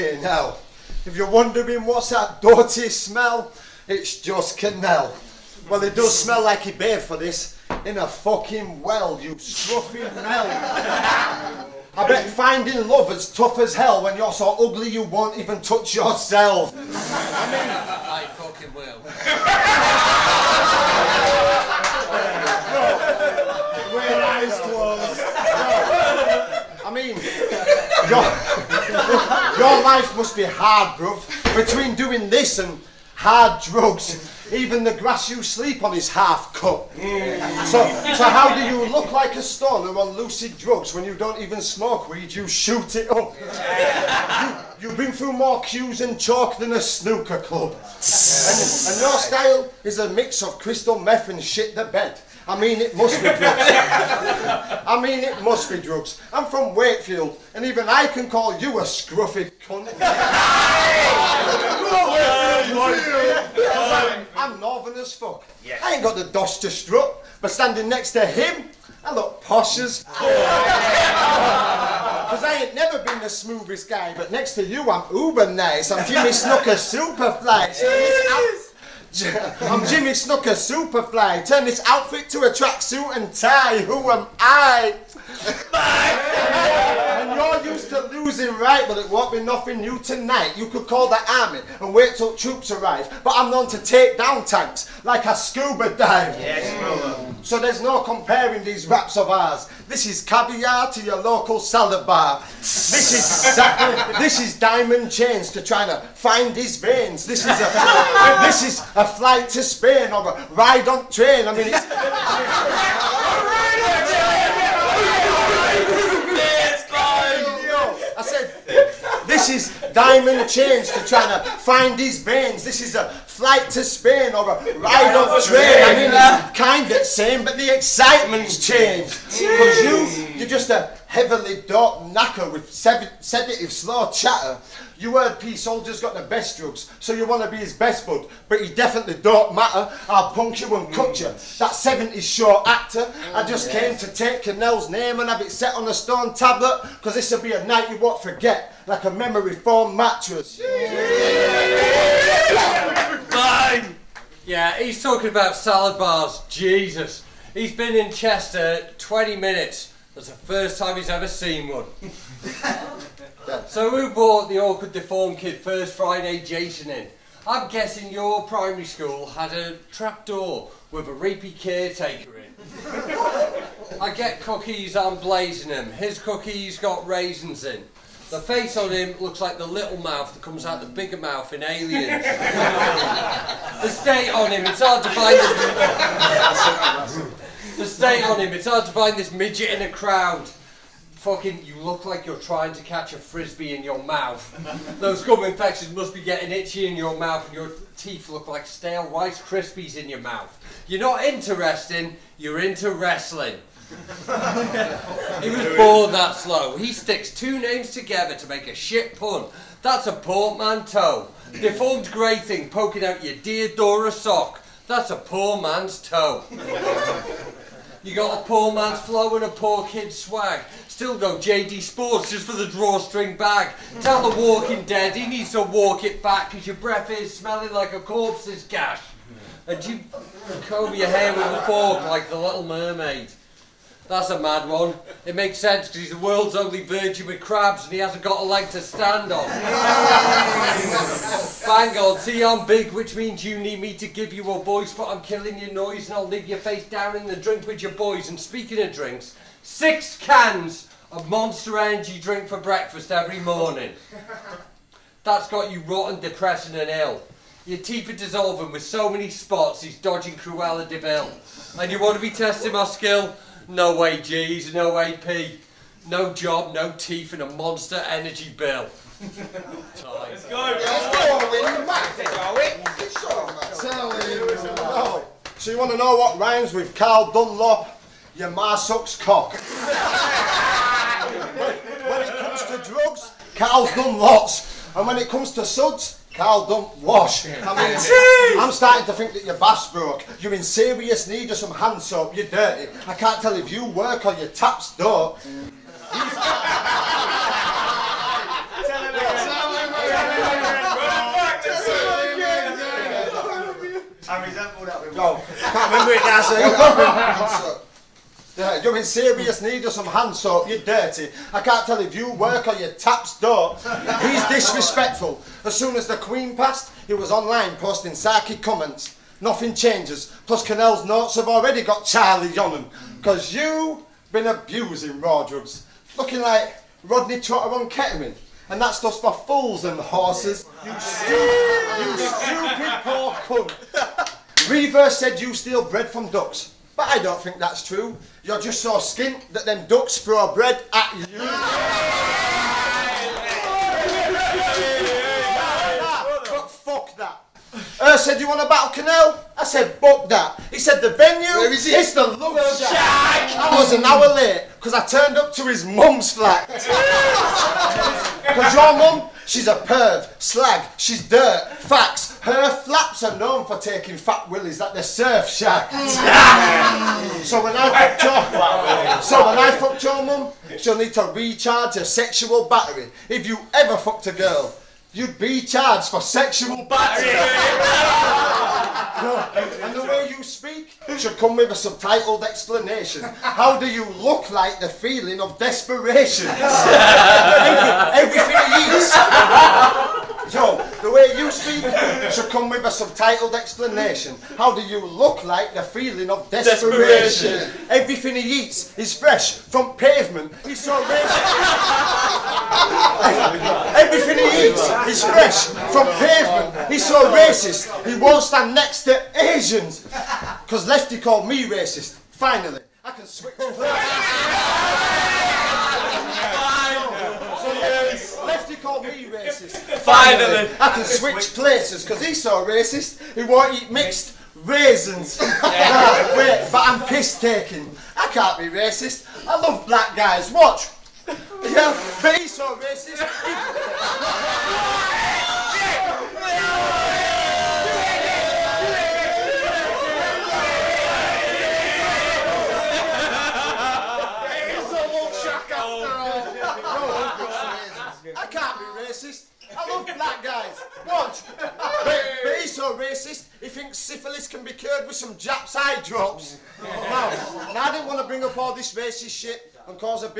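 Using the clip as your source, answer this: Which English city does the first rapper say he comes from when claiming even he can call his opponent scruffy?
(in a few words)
Wakefield.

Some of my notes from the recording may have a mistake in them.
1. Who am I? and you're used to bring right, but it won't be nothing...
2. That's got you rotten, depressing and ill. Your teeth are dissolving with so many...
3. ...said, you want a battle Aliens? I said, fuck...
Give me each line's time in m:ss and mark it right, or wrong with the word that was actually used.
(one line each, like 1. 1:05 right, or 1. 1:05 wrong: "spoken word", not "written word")
1. 1:23 wrong: "losing", not "bring"
2. 4:15 right
3. 5:48 wrong: "Kinell", not "Aliens".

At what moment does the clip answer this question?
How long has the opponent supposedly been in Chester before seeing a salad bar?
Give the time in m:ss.
2:38.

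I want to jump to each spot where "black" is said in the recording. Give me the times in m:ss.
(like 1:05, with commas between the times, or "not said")
7:09, 7:30.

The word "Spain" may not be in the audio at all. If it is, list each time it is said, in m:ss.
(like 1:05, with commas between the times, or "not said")
1:49, 2:03.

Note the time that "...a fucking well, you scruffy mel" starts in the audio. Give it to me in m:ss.
0:07.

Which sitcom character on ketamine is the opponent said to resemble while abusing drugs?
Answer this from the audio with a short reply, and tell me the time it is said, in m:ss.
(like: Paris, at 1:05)
Rodney Trotter, at 5:27.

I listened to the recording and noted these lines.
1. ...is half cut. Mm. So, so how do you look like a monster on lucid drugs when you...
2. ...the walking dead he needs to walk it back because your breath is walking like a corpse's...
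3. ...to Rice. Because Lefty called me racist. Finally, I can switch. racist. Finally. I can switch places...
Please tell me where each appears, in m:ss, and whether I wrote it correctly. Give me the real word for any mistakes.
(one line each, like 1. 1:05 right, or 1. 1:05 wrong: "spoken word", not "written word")
1. 0:35 wrong: "stoner", not "monster"
2. 3:44 wrong: "smelling", not "walking"
3. 6:49 wrong: "Asians", not "Rice".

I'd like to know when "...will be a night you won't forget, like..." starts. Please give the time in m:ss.
2:27.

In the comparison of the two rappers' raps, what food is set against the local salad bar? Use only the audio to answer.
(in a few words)
Caviar.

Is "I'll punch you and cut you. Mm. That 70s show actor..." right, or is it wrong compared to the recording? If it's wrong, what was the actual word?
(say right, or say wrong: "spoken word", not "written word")
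right.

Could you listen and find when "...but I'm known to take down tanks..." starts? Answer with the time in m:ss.
1:33.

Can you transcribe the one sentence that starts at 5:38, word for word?
You're just so skint that them ducks throw bread at you.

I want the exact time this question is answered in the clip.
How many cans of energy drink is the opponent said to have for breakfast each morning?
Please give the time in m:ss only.
4:09.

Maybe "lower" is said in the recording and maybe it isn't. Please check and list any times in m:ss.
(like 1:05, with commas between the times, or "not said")
not said.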